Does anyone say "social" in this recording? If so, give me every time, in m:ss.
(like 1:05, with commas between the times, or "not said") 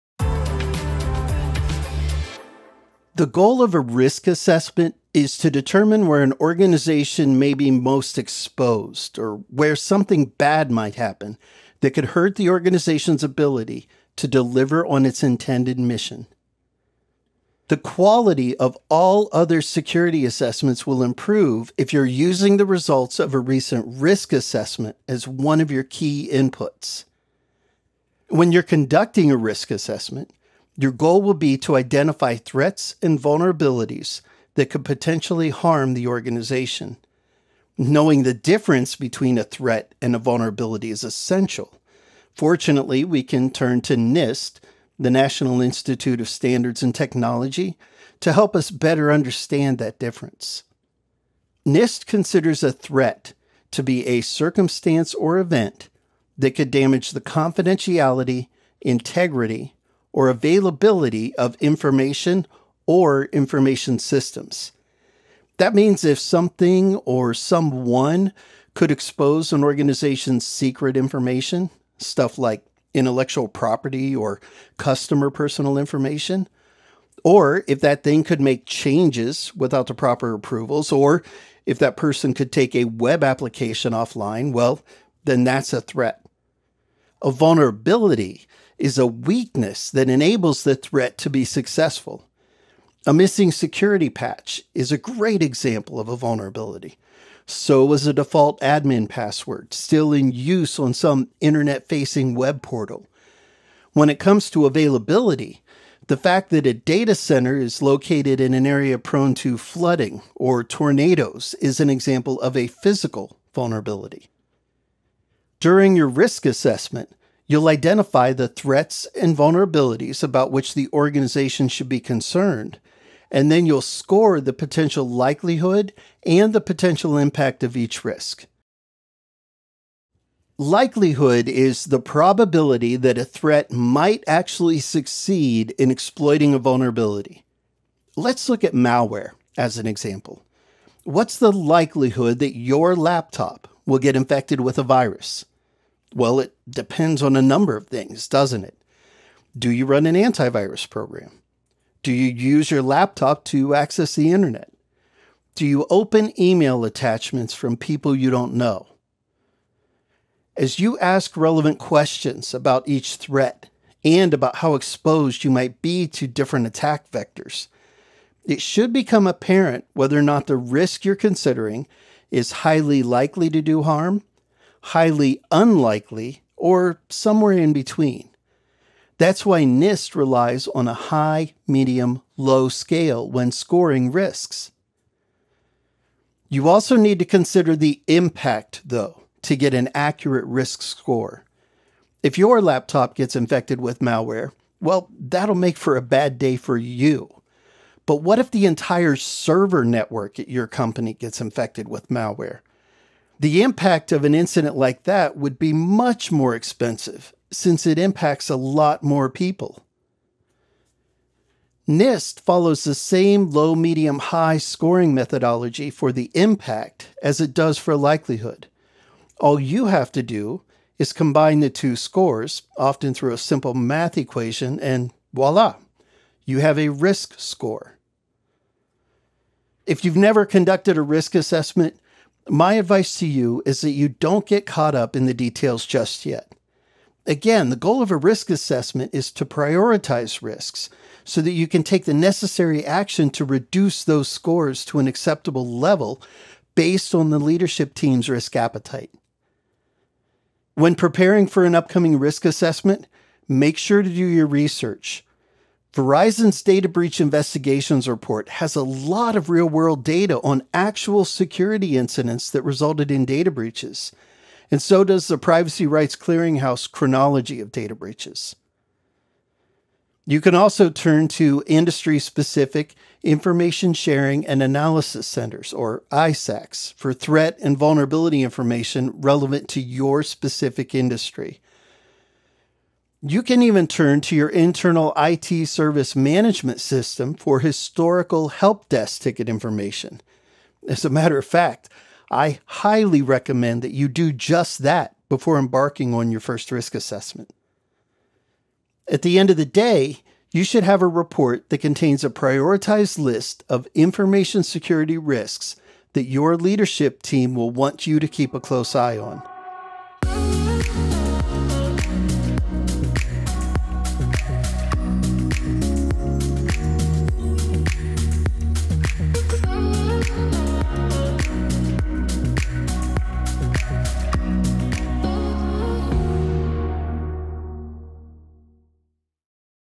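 not said.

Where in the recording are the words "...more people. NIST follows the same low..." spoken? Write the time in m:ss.
3:29.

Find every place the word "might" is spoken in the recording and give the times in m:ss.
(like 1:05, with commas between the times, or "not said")
0:10, 2:13, 2:45.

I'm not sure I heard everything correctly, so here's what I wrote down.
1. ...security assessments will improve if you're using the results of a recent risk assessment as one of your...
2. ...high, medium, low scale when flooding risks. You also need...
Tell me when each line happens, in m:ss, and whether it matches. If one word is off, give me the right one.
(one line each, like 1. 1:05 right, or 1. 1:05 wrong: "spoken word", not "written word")
1. 0:19 right
2. 3:00 wrong: "scoring", not "flooding".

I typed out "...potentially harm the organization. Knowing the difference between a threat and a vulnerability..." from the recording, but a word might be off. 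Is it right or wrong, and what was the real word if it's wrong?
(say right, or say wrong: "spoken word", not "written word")
right.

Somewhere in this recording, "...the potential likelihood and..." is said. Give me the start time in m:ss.
2:04.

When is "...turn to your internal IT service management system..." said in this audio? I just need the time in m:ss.
4:43.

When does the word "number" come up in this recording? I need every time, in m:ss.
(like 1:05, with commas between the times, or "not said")
2:27.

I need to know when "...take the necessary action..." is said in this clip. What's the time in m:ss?
4:01.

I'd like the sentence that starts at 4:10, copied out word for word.
When preparing for an upcoming risk assessment, make sure to do your research.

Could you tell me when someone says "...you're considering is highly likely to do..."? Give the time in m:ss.
2:51.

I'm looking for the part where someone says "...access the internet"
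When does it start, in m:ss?
2:33.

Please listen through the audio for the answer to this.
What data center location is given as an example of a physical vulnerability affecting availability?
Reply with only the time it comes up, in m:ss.
1:48.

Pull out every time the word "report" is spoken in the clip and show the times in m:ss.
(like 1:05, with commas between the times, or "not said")
4:18, 5:01.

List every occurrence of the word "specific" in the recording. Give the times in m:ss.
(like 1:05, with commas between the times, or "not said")
4:32, 4:40.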